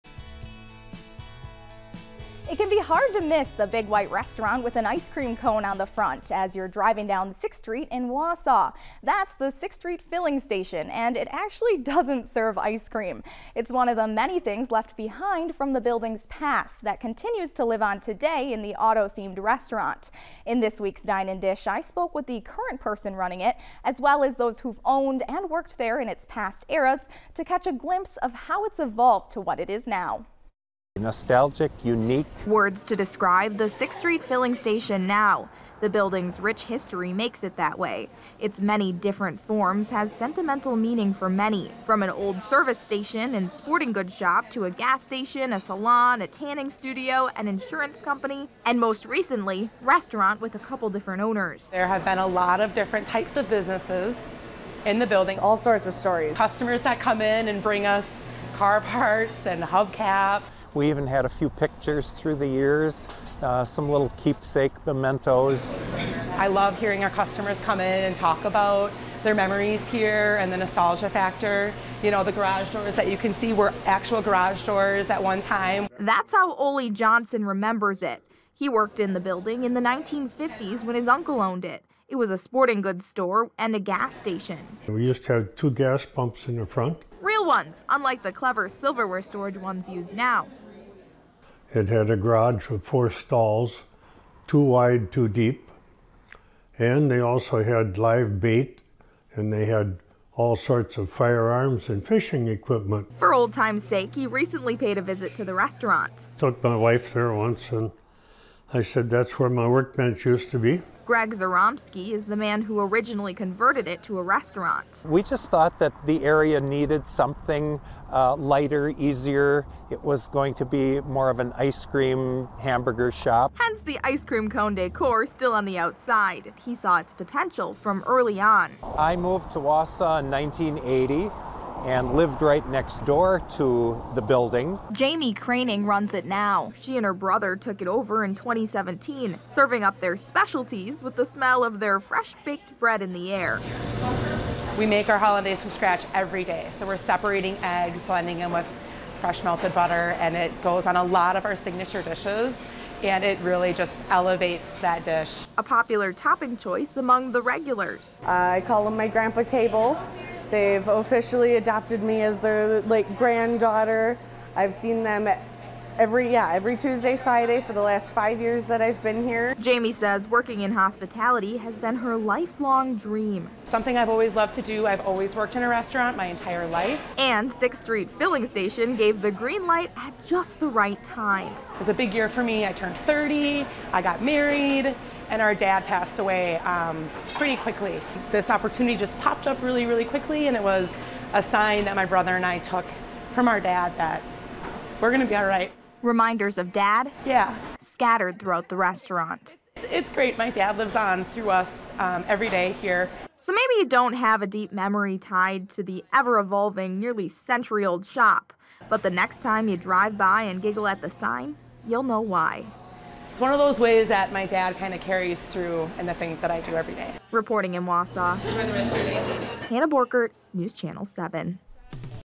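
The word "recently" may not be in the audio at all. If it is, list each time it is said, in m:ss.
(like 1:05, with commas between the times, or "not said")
0:49, 1:44.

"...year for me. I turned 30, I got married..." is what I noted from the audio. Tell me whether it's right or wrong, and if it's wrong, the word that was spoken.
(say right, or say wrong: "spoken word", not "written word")
right.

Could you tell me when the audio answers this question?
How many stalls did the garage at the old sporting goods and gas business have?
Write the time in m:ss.
1:32.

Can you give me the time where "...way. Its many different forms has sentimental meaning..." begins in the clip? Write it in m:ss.
0:37.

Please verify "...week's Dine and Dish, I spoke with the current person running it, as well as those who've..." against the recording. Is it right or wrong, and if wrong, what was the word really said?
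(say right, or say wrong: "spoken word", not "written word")
right.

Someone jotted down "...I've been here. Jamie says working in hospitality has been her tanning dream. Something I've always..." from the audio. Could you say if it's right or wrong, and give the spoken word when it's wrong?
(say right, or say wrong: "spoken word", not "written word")
wrong: "lifelong", not "tanning".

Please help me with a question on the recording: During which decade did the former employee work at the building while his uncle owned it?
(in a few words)
1950s.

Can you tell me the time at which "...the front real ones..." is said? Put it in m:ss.
1:26.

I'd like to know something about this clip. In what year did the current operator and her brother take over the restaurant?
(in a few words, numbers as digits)
2017.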